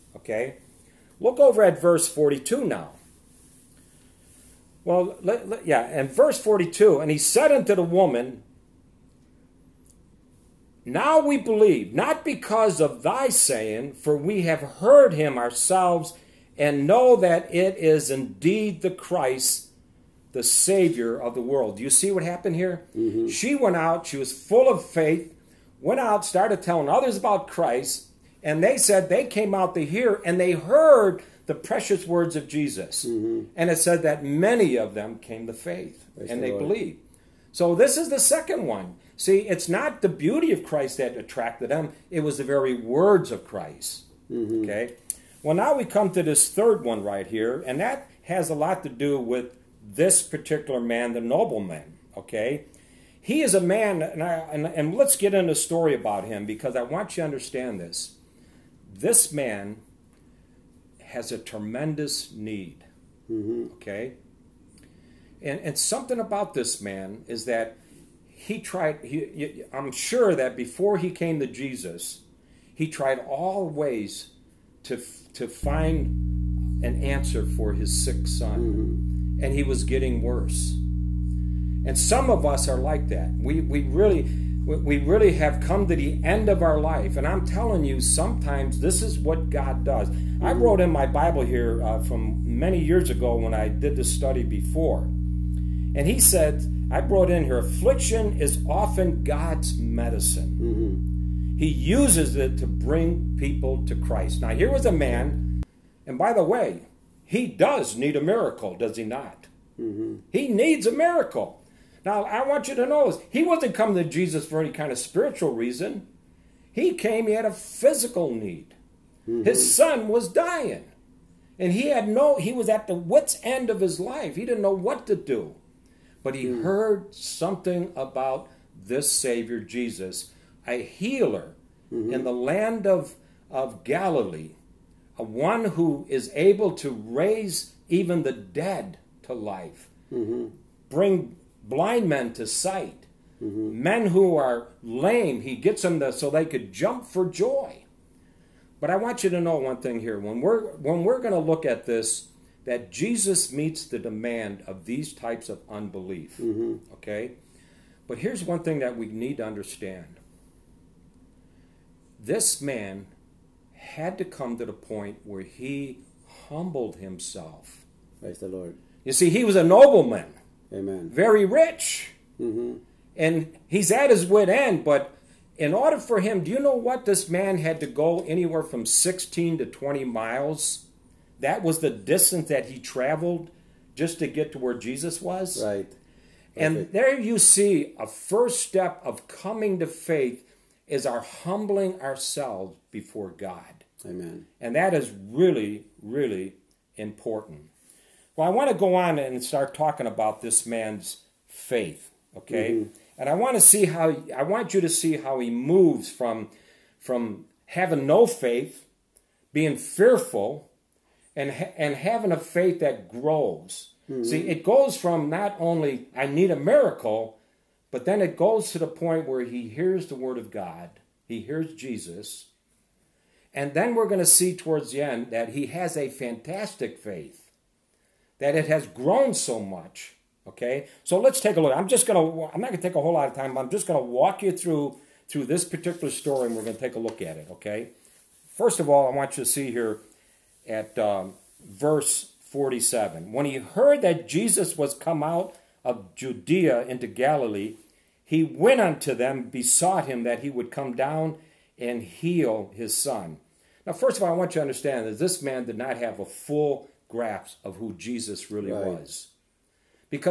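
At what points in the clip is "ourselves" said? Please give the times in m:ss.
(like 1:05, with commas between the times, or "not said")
0:15, 3:11.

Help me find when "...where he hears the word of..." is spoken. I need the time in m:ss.
3:39.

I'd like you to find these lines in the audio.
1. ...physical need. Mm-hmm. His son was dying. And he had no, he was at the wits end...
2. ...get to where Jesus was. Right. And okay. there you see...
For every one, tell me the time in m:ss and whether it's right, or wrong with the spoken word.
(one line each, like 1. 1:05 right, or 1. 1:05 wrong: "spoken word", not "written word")
1. 1:57 right
2. 3:04 right.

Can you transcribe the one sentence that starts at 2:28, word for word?
But I want you to know one thing here.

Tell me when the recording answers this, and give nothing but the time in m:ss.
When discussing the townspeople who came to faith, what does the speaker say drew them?
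0:42.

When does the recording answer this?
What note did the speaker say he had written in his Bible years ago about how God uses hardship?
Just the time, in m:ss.
1:37.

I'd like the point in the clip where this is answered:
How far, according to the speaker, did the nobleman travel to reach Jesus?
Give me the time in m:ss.
2:58.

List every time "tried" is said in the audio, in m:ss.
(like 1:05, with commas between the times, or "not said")
1:08, 1:12.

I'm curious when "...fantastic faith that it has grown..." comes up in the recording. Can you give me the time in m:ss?
3:46.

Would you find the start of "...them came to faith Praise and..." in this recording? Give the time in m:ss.
0:34.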